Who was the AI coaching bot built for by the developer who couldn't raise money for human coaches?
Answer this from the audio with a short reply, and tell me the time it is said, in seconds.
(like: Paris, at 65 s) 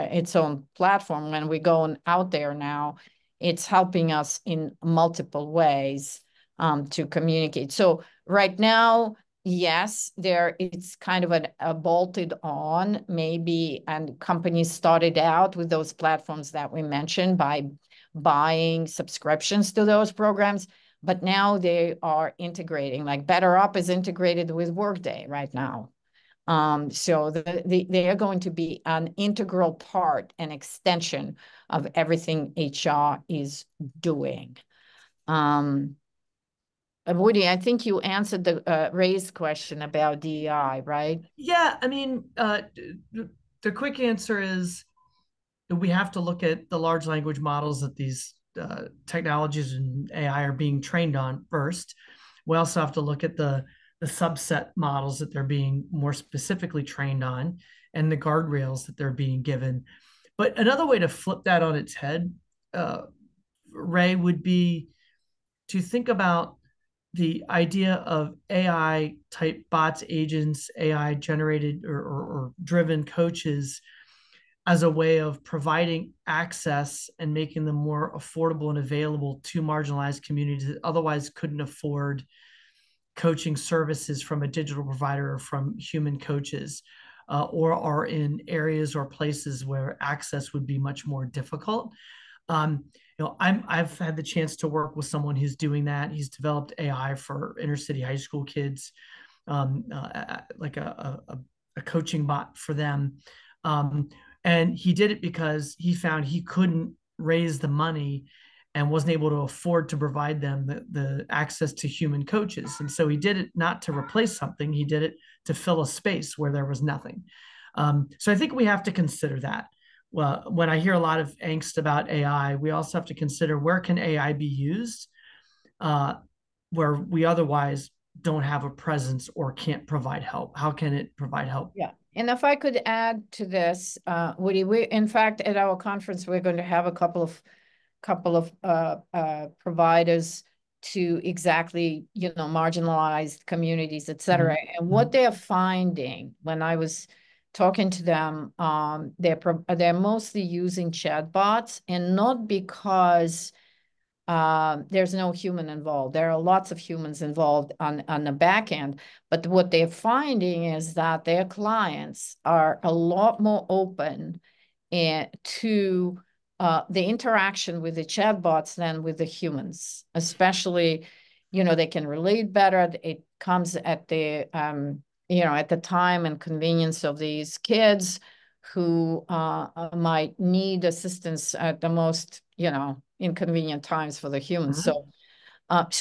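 Inner city high school kids, at 97 s.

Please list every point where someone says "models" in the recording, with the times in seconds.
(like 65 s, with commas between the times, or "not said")
47 s, 54 s.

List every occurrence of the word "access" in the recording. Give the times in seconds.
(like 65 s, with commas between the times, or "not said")
76 s, 89 s, 111 s.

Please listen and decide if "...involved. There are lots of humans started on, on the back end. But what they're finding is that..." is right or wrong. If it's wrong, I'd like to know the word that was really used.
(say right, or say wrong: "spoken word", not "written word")
wrong: "involved", not "started".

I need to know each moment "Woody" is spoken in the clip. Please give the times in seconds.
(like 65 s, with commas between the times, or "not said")
37 s, 134 s.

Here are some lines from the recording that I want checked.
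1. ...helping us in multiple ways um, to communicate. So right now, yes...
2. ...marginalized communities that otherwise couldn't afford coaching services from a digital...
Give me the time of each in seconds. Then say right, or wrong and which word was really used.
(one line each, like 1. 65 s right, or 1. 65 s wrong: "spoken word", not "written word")
1. 3 s right
2. 79 s right.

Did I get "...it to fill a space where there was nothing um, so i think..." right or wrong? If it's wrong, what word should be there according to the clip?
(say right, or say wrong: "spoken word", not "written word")
right.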